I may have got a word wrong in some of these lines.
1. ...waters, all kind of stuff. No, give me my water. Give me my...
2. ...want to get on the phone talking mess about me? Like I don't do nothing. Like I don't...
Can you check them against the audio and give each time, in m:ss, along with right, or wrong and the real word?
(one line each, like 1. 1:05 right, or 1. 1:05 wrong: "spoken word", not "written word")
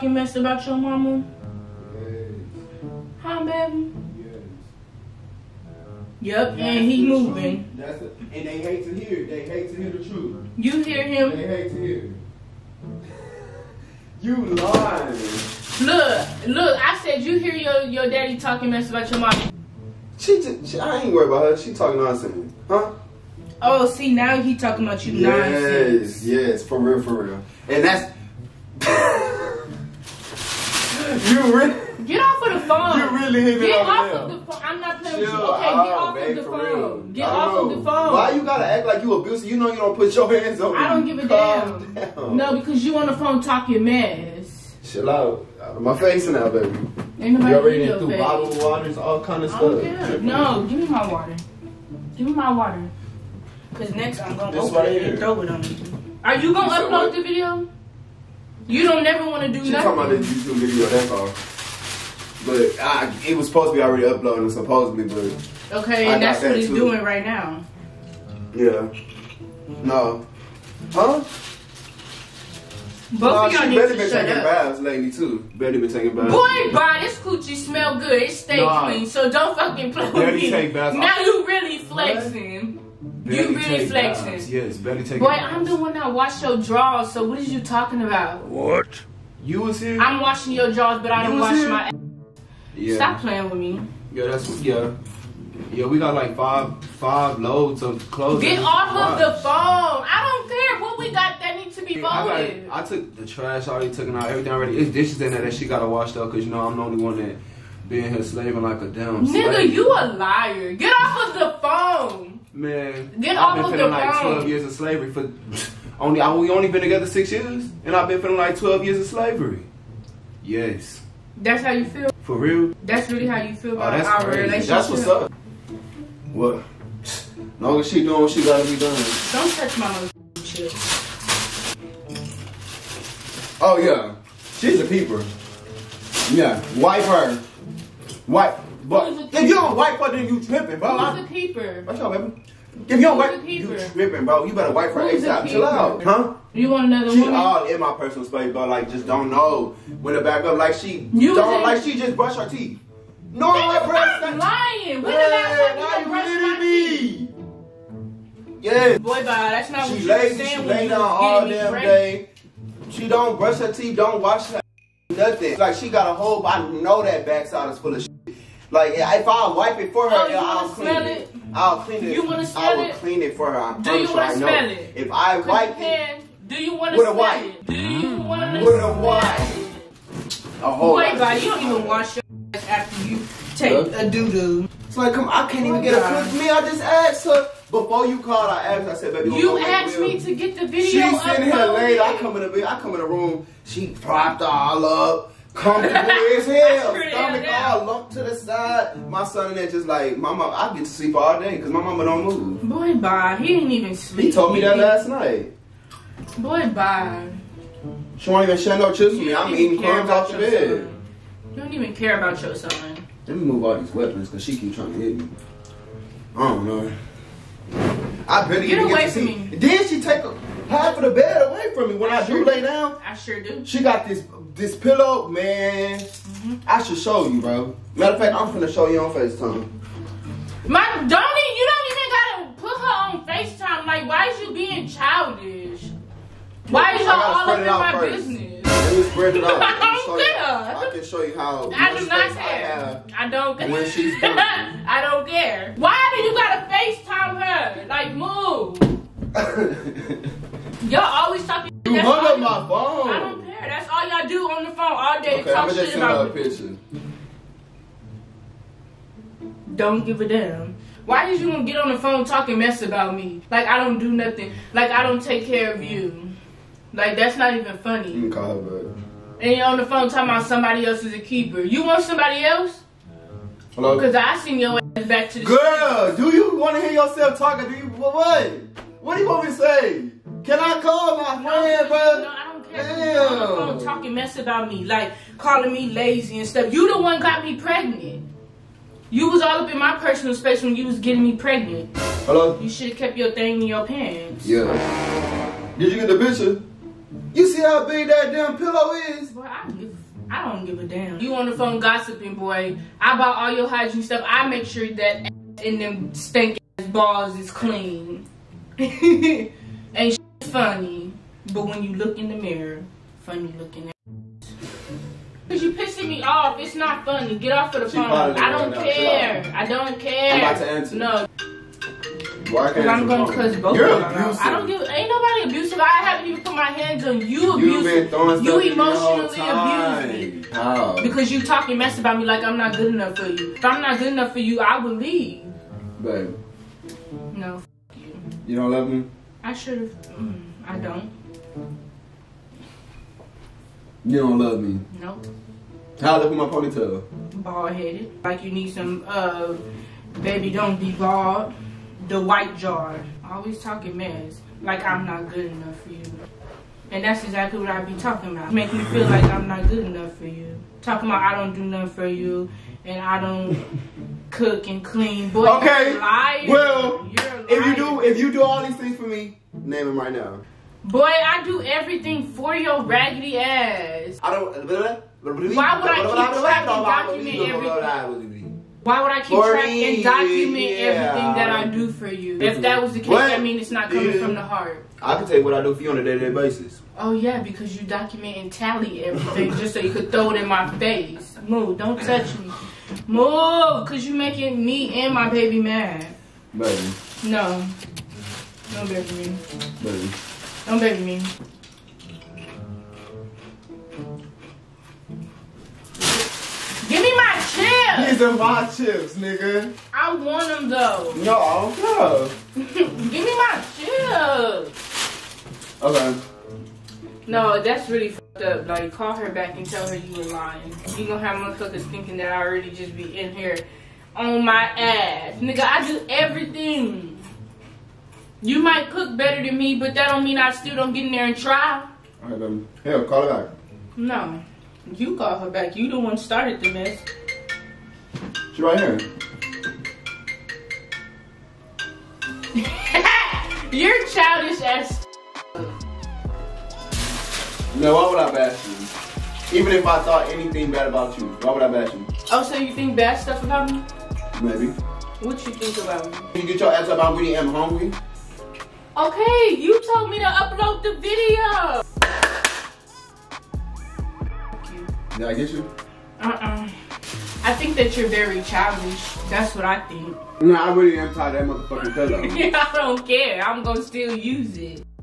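1. 0:48 right
2. 4:21 right.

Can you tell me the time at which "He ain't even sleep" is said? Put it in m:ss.
3:23.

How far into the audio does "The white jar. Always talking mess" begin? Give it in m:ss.
5:52.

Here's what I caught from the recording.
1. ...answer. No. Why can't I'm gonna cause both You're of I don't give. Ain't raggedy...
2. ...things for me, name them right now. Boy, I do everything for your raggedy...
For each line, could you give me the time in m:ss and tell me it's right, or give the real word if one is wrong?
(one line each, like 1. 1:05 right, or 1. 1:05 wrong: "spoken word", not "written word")
1. 5:20 wrong: "nobody", not "raggedy"
2. 6:08 right.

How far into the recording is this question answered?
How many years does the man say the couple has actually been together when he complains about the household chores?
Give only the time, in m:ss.
1:57.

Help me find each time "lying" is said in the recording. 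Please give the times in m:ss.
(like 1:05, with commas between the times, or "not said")
0:14, 2:34, 7:00.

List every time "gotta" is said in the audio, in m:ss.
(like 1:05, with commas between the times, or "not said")
0:38, 1:45, 2:08, 3:52, 4:06.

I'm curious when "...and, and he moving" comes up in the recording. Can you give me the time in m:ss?
0:06.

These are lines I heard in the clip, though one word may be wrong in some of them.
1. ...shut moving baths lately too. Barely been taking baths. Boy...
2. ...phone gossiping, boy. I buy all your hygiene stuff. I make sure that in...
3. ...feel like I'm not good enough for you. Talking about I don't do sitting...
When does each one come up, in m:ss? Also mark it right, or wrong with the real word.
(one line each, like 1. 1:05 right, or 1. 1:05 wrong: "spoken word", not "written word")
1. 1:14 wrong: "taking", not "moving"
2. 5:01 right
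3. 5:58 wrong: "nothing", not "sitting".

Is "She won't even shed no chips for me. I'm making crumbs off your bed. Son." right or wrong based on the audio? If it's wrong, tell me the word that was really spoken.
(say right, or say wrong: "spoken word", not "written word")
wrong: "eating", not "making".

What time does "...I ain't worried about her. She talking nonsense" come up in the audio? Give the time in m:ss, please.
0:20.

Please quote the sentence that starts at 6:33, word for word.
Move, cause you you're making me and my baby mad.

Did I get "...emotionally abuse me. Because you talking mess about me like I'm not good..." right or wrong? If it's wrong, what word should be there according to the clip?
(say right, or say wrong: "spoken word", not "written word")
right.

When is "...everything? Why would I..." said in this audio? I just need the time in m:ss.
6:17.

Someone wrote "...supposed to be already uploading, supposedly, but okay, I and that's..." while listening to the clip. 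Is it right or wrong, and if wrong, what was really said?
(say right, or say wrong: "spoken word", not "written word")
right.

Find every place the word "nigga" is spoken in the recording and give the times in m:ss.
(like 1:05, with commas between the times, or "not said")
1:49, 6:49, 7:05.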